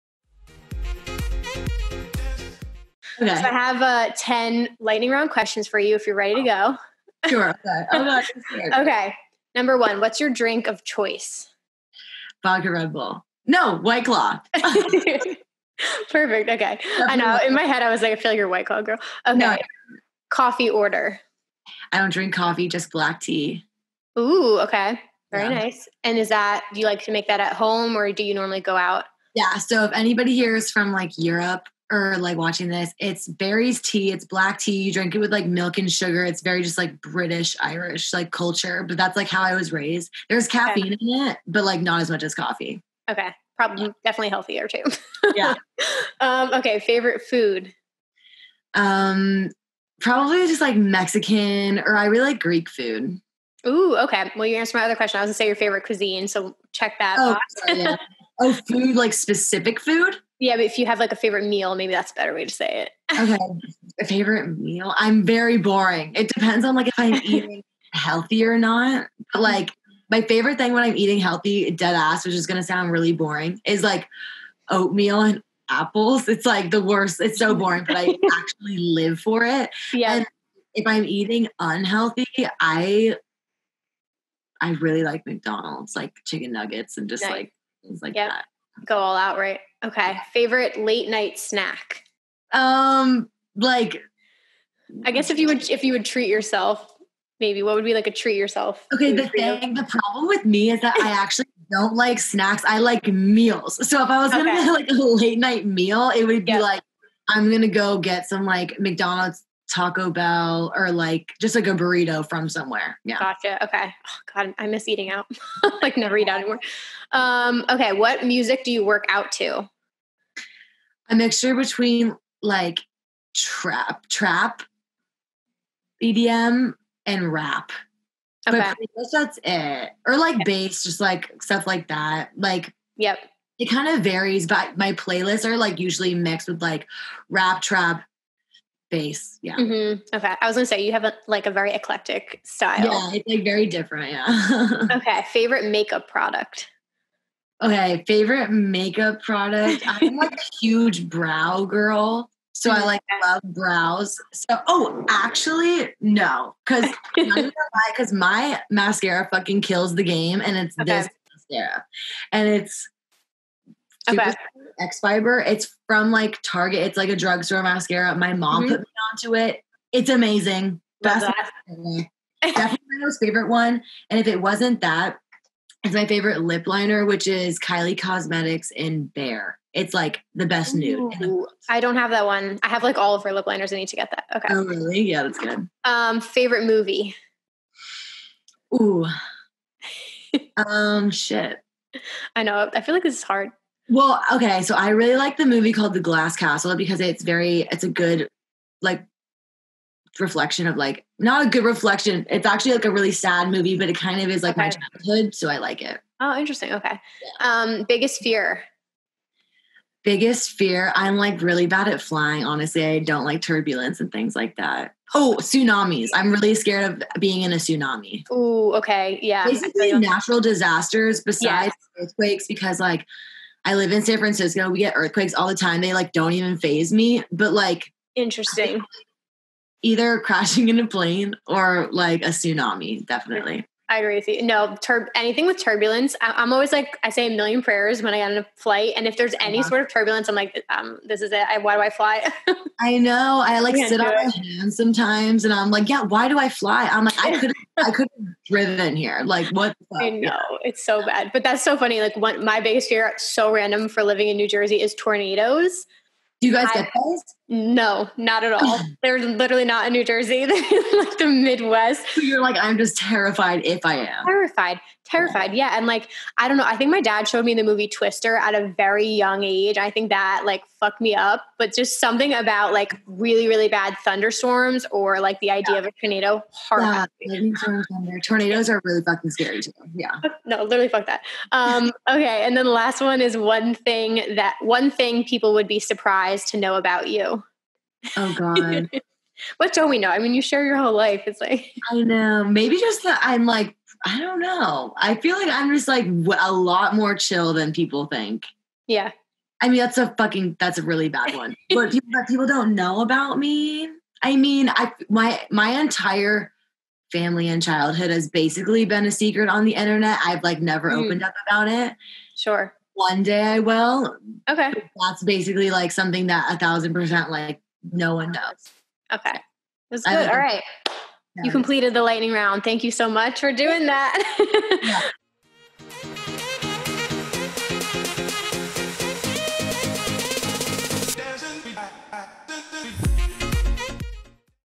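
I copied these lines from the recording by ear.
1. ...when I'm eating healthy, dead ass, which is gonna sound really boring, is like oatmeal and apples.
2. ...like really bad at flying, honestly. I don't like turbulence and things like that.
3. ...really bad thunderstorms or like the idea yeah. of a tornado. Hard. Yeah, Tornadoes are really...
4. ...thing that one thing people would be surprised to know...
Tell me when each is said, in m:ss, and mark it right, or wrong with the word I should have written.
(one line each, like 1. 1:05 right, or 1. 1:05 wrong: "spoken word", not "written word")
1. 1:10 right
2. 3:31 right
3. 4:33 right
4. 4:43 right.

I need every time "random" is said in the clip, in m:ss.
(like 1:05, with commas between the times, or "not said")
4:13.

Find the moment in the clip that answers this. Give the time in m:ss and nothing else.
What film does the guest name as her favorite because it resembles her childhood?
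3:15.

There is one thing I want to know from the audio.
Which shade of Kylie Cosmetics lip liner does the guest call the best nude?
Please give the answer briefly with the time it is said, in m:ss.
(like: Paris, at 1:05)
Bear, at 2:59.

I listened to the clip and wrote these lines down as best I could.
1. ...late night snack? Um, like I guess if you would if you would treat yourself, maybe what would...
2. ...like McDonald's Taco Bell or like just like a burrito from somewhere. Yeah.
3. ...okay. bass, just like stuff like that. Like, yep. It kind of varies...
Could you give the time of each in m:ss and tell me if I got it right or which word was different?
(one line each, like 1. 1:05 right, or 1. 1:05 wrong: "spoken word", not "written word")
1. 1:30 right
2. 1:48 right
3. 2:10 right.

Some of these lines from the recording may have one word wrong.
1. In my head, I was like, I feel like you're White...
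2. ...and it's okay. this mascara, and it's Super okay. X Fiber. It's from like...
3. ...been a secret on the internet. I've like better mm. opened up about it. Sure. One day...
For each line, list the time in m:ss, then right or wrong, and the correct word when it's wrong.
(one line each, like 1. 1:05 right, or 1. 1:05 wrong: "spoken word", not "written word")
1. 0:17 right
2. 2:40 right
3. 5:08 wrong: "never", not "better".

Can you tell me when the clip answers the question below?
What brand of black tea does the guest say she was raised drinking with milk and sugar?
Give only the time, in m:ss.
0:33.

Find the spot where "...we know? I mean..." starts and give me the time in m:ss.
4:49.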